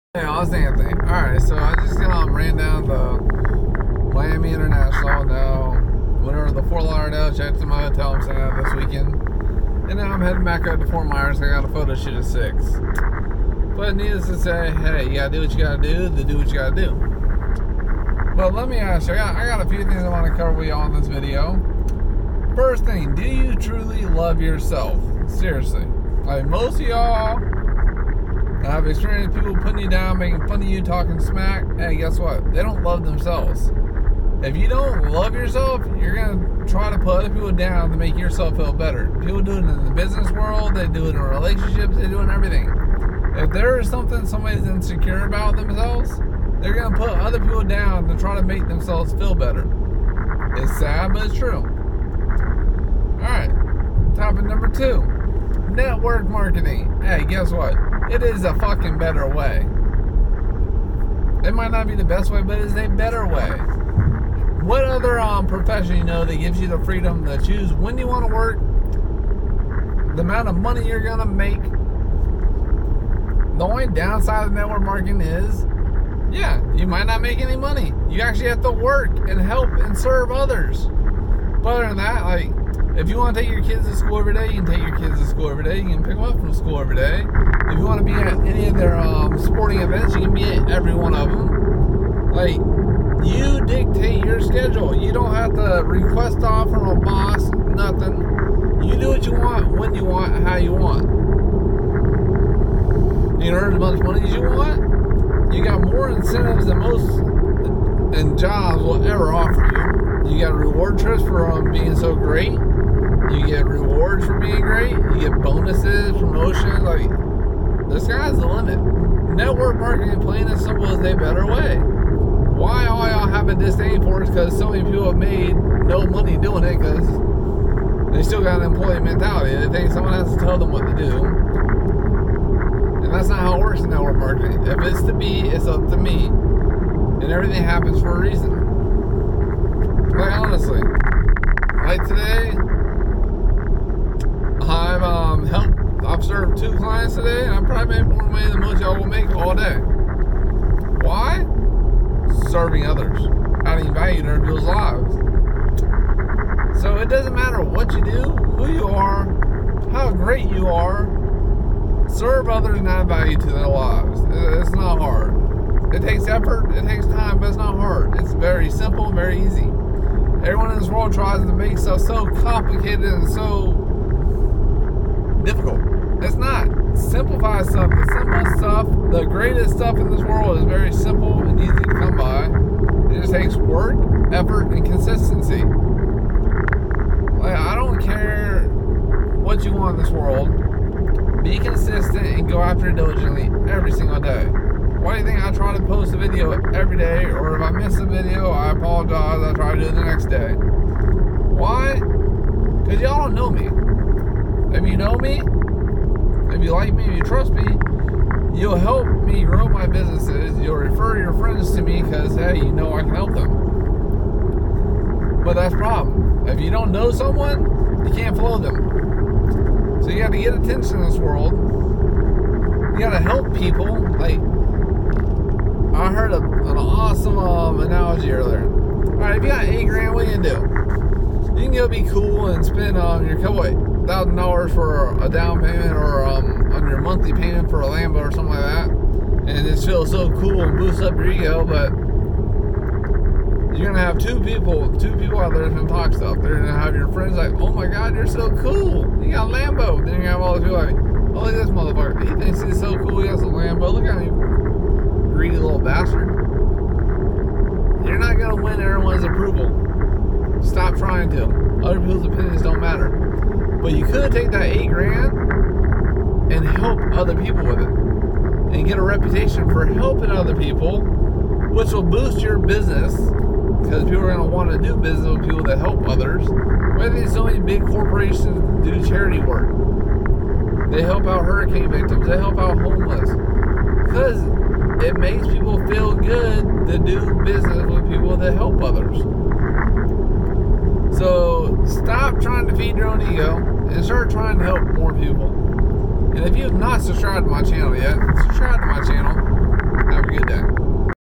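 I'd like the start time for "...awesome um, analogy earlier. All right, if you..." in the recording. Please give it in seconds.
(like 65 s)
226 s.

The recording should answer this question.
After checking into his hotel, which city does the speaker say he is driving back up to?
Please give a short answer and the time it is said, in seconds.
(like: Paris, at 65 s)
Fort Myers, at 10 s.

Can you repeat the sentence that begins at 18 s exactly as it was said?
But let me ask you, I got, I got a few things I want to cover with you in this video.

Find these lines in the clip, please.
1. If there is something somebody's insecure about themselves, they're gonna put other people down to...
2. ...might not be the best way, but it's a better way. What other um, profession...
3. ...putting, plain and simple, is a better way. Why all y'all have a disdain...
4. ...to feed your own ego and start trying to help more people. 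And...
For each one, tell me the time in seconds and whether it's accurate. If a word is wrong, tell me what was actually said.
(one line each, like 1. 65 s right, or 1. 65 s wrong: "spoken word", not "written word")
1. 43 s right
2. 61 s right
3. 119 s wrong: "marketing", not "putting"
4. 292 s right.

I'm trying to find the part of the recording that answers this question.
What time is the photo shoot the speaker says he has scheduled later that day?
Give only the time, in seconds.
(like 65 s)
12 s.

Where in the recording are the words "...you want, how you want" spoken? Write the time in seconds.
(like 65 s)
99 s.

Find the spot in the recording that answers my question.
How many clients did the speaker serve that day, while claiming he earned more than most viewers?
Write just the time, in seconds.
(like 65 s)
146 s.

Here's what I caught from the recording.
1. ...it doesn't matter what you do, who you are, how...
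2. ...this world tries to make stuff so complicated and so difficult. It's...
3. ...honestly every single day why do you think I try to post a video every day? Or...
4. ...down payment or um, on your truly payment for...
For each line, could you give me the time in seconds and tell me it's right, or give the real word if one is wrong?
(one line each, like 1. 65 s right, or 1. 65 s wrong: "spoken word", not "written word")
1. 156 s right
2. 170 s right
3. 192 s wrong: "diligently", not "honestly"
4. 235 s wrong: "monthly", not "truly".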